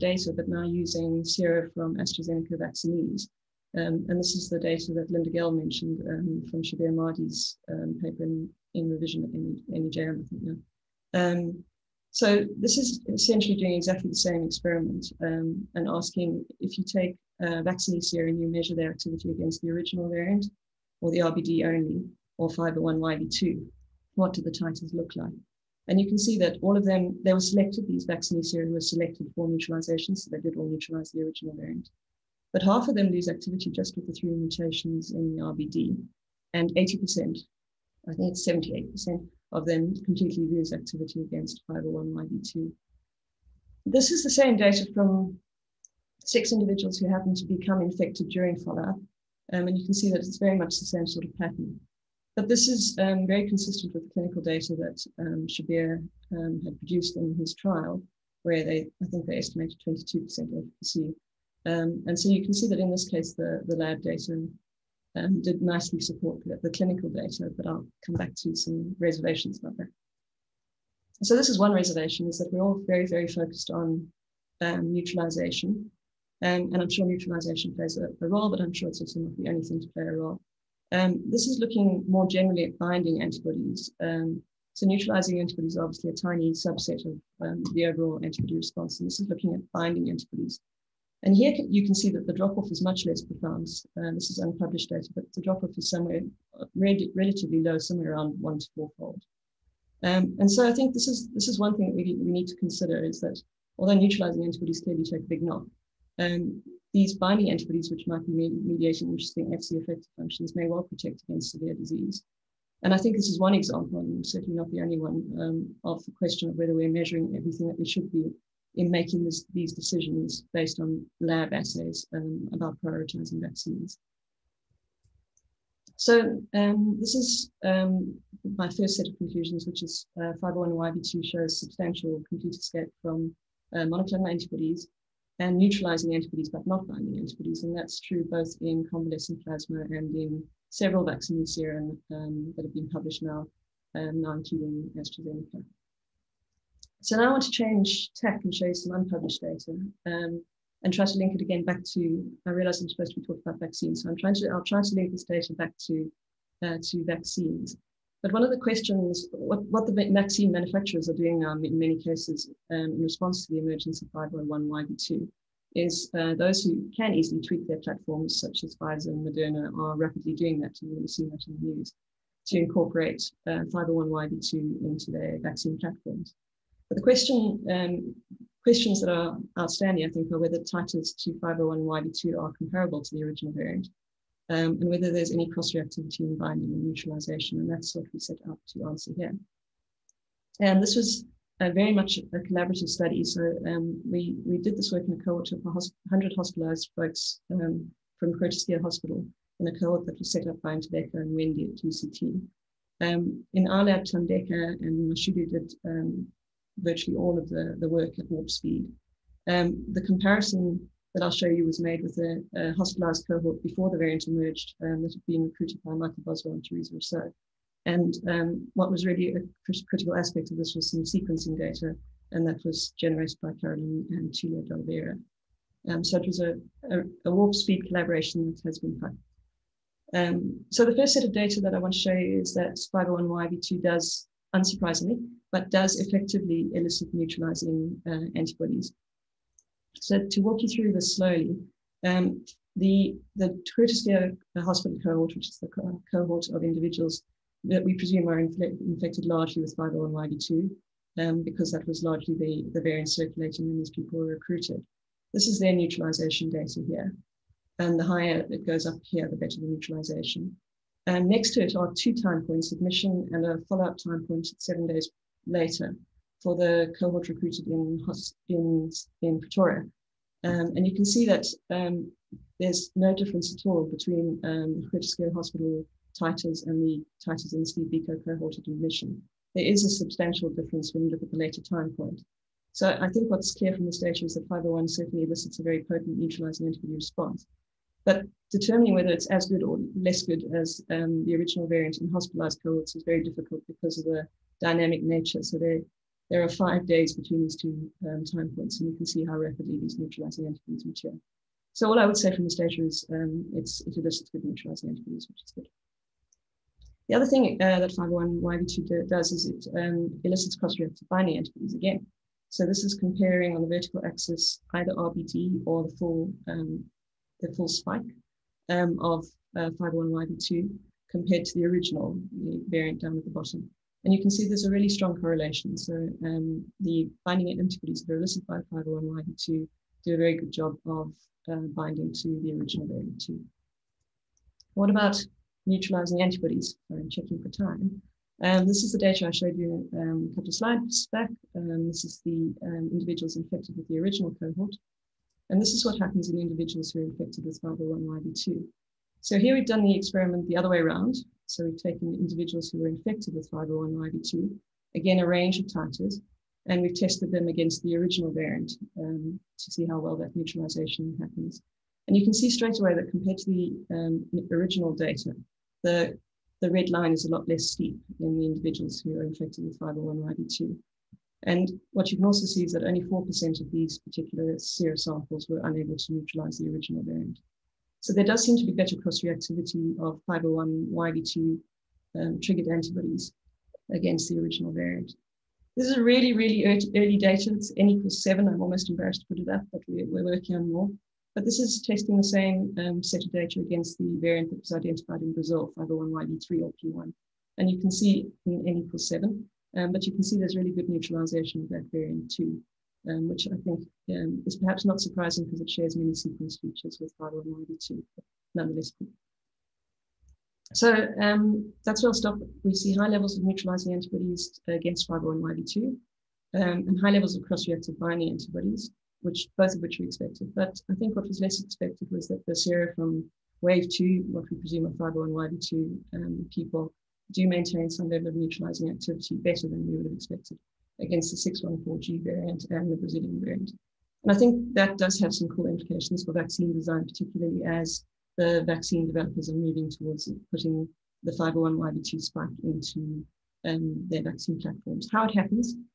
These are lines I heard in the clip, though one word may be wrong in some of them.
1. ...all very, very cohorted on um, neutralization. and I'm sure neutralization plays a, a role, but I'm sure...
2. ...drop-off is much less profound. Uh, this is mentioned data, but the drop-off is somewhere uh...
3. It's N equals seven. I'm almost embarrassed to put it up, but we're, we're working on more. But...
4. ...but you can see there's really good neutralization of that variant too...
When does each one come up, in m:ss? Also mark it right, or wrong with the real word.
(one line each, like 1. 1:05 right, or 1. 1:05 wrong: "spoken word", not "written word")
1. 1:12 wrong: "focused", not "cohorted"
2. 1:32 wrong: "unpublished", not "mentioned"
3. 6:27 right
4. 6:39 right.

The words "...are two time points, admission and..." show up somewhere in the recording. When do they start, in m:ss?
4:21.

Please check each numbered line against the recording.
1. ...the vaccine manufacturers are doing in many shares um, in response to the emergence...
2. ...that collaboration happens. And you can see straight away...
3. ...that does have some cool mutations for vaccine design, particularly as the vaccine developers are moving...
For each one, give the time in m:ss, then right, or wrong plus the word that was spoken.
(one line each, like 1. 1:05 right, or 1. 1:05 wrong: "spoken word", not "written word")
1. 2:39 wrong: "cases", not "shares"
2. 6:00 wrong: "neutralization", not "collaboration"
3. 7:14 wrong: "implications", not "mutations".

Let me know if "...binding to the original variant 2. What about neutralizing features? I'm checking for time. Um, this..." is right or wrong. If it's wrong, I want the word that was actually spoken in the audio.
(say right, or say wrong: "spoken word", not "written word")
wrong: "antibodies", not "features".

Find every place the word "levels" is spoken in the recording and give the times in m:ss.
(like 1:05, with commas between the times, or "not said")
6:53, 6:57, 7:08.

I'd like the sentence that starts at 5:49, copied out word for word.
So here we've done the experiment the other way around.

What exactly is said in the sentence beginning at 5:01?
So all I would say from this data is um, it's, it elicits good neutralizing antibodies, which is good.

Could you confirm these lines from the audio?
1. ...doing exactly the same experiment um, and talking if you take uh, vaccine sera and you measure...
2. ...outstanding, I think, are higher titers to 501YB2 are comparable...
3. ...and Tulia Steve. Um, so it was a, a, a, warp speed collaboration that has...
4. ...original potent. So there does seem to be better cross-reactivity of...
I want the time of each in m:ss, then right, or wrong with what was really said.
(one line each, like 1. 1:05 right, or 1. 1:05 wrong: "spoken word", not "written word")
1. 0:13 wrong: "asking", not "talking"
2. 2:59 wrong: "whether", not "higher"
3. 3:44 wrong: "Delvera", not "Steve"
4. 6:16 wrong: "variant", not "potent".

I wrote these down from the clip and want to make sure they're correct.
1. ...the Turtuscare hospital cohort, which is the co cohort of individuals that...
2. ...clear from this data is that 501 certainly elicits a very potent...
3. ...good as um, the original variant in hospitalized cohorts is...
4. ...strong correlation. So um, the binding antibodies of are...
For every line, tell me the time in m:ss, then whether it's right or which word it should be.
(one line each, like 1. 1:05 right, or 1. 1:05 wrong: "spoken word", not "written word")
1. 4:03 right
2. 4:43 right
3. 4:50 right
4. 5:24 right.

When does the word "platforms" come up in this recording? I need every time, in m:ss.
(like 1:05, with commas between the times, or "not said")
2:47, 2:55, 7:24.